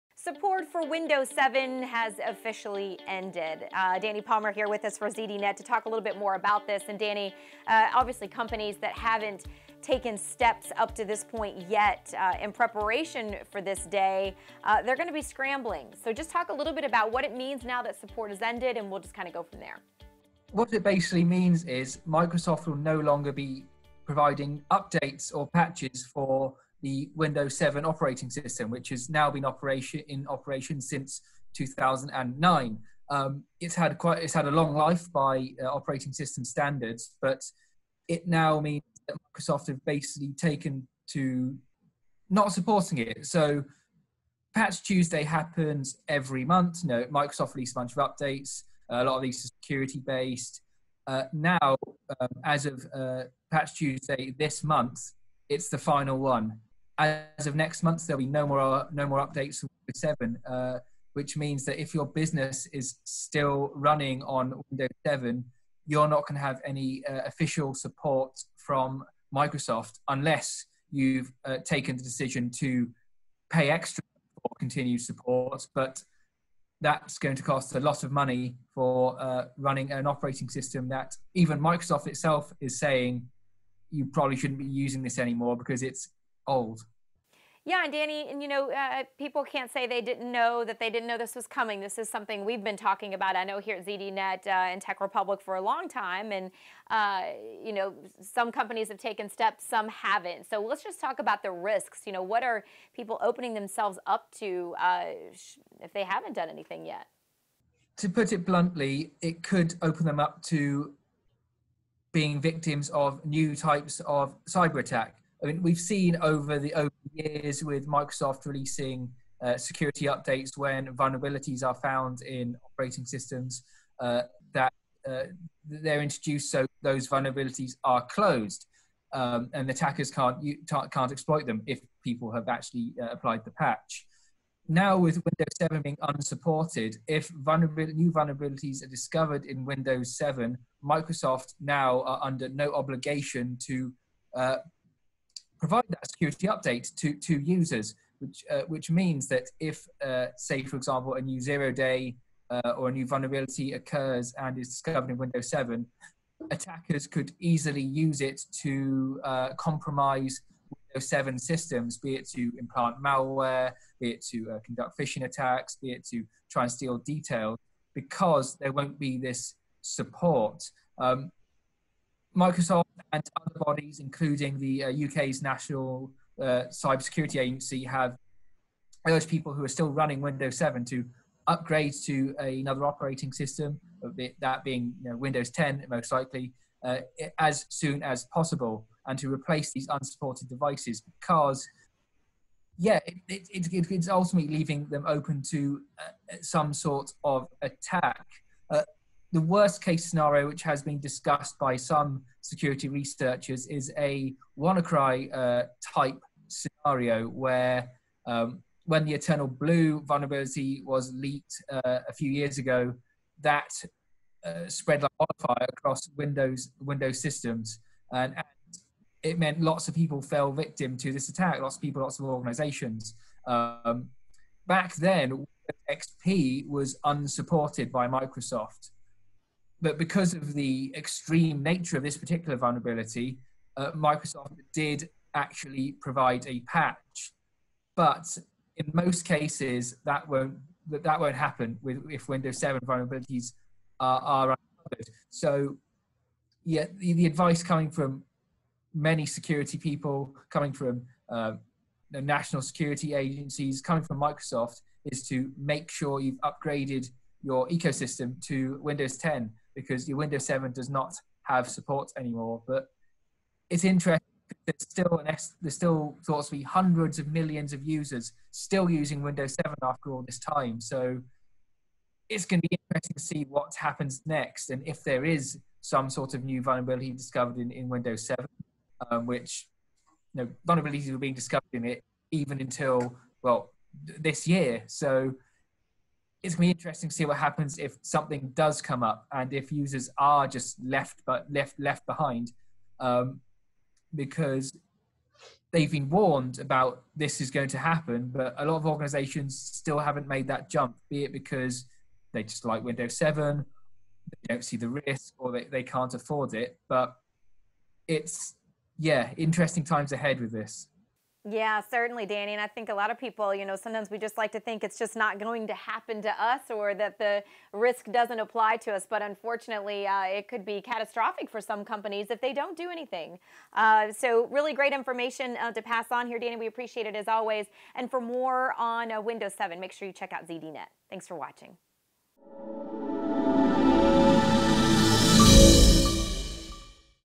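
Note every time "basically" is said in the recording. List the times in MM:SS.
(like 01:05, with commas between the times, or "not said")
00:20, 00:39.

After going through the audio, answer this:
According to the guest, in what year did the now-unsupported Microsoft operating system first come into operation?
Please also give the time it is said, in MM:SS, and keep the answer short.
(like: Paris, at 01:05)
2009, at 00:31.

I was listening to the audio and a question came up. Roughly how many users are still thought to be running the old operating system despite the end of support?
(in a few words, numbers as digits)
hundreds of millions.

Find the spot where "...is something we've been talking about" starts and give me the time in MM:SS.
01:31.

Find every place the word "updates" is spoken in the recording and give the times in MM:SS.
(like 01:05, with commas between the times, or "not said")
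00:24, 00:47, 00:59, 02:00, 02:26.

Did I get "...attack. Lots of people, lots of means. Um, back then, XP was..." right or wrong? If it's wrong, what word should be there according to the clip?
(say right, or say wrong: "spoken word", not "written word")
wrong: "organizations", not "means".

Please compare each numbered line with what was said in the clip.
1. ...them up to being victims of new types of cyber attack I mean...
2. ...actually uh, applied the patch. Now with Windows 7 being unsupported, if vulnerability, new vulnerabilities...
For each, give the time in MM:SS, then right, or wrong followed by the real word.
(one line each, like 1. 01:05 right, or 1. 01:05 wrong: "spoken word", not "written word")
1. 01:50 right
2. 02:12 right.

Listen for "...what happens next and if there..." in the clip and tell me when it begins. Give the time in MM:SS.
04:33.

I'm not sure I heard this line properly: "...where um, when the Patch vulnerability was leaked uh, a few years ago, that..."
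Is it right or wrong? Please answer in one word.
wrong.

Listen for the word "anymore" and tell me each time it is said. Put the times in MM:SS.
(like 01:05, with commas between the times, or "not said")
01:25, 04:22.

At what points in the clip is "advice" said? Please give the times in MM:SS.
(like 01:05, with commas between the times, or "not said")
04:07.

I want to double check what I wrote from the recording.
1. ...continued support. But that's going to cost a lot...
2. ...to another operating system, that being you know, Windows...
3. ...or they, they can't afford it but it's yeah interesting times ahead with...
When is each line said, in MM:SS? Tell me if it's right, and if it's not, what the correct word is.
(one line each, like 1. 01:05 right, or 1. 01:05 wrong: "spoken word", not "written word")
1. 01:14 right
2. 03:02 right
3. 05:05 right.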